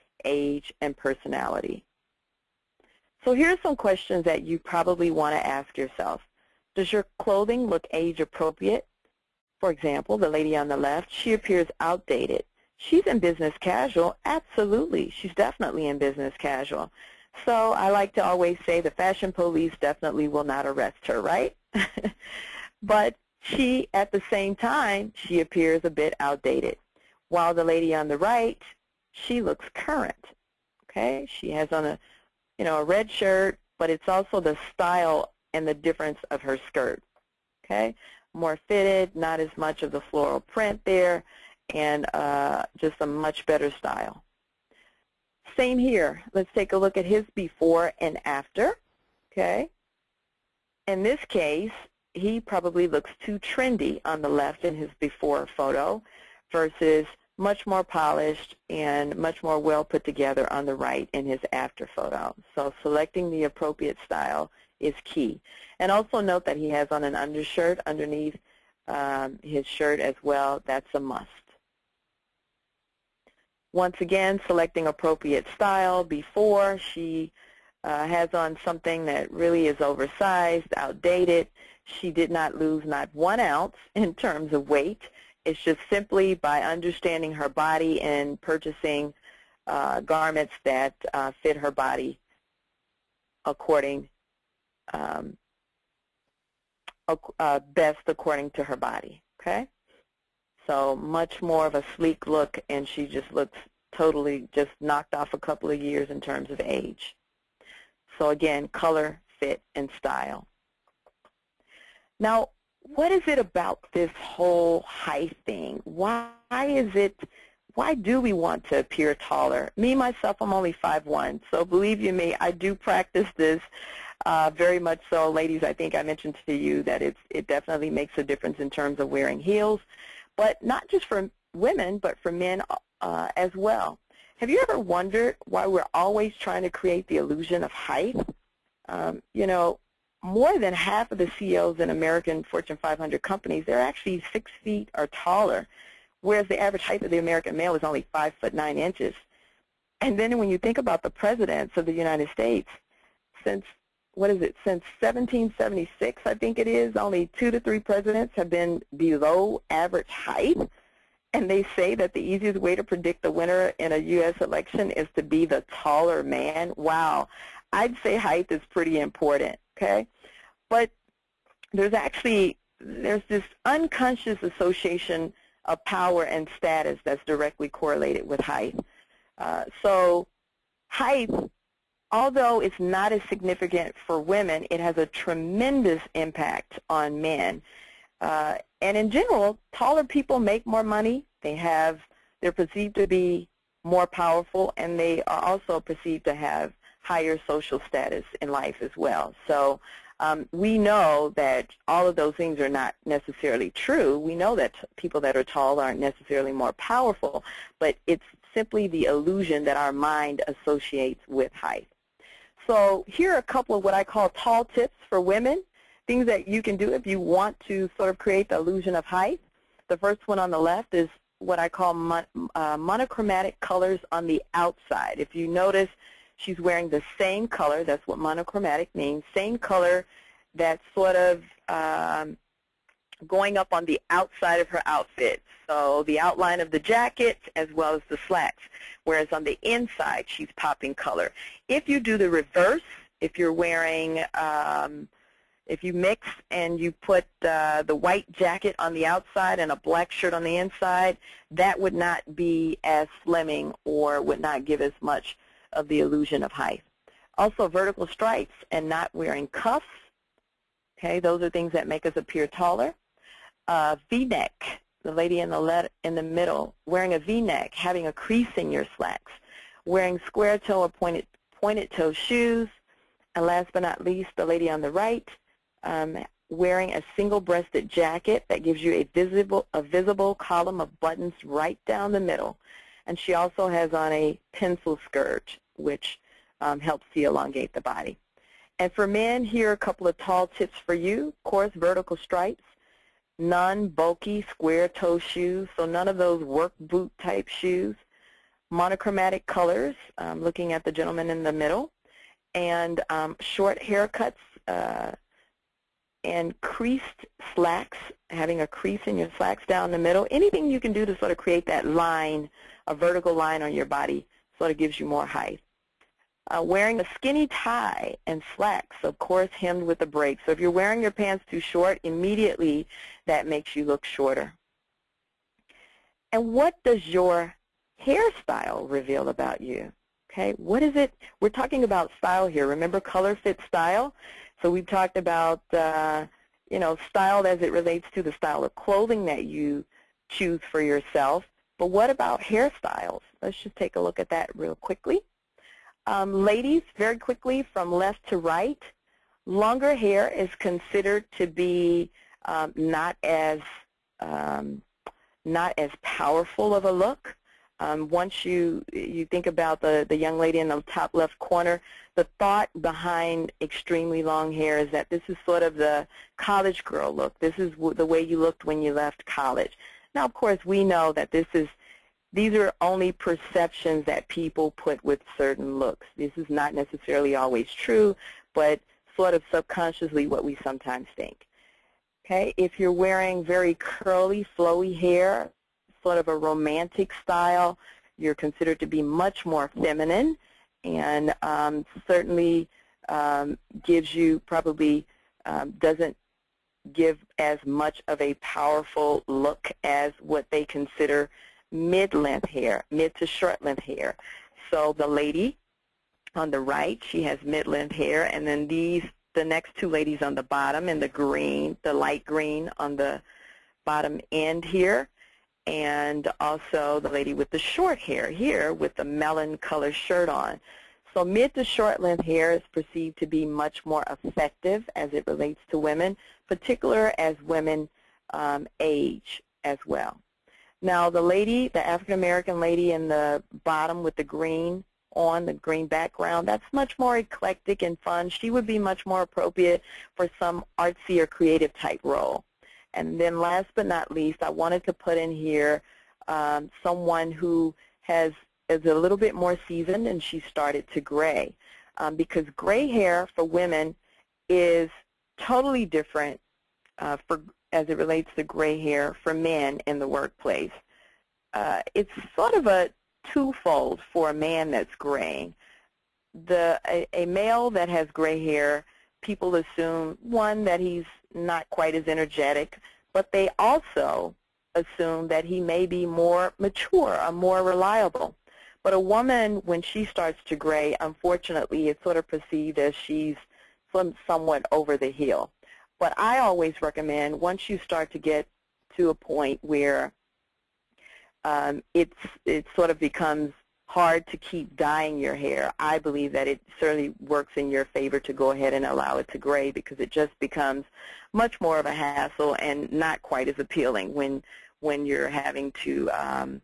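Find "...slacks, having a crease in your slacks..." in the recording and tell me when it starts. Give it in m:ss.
5:07.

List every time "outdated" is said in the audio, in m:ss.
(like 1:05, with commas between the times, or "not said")
0:11, 0:26, 1:20.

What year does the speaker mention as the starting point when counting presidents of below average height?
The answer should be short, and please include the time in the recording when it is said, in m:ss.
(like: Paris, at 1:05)
1776, at 2:34.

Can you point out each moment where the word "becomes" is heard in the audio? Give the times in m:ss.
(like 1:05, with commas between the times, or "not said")
8:12, 8:20.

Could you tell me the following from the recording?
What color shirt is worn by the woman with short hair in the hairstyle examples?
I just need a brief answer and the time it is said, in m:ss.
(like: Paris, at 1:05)
Melon, at 6:59.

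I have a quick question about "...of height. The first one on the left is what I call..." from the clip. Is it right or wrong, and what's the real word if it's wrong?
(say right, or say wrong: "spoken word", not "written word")
right.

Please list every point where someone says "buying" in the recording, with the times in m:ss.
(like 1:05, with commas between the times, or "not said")
not said.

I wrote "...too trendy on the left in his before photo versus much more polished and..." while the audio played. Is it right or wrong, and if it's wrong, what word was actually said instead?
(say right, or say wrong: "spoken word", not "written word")
right.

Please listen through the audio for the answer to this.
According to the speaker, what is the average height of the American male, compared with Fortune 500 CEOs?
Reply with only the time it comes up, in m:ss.
2:28.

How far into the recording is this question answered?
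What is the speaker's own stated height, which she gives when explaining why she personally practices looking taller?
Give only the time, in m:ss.
2:00.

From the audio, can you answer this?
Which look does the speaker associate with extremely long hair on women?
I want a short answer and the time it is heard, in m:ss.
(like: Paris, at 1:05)
College girl look, at 6:06.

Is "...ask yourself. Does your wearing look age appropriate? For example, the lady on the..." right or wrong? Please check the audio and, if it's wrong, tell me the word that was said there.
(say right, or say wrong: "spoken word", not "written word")
wrong: "clothing", not "wearing".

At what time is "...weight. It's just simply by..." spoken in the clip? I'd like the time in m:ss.
1:24.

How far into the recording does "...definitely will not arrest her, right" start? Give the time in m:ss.
0:19.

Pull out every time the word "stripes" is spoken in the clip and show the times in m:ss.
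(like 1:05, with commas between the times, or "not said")
4:18, 4:52.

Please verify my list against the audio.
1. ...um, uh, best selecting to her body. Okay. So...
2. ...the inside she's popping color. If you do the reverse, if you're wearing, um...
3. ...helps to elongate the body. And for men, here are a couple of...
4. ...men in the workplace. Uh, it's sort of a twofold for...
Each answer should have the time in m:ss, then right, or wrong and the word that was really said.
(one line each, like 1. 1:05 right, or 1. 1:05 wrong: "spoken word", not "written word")
1. 1:34 wrong: "according", not "selecting"
2. 3:59 right
3. 4:46 right
4. 7:39 right.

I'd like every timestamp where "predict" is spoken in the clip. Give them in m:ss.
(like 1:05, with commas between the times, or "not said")
2:42.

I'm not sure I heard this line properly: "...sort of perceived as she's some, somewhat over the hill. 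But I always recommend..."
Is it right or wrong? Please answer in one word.
right.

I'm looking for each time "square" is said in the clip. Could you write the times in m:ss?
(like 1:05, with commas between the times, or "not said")
4:30, 4:54.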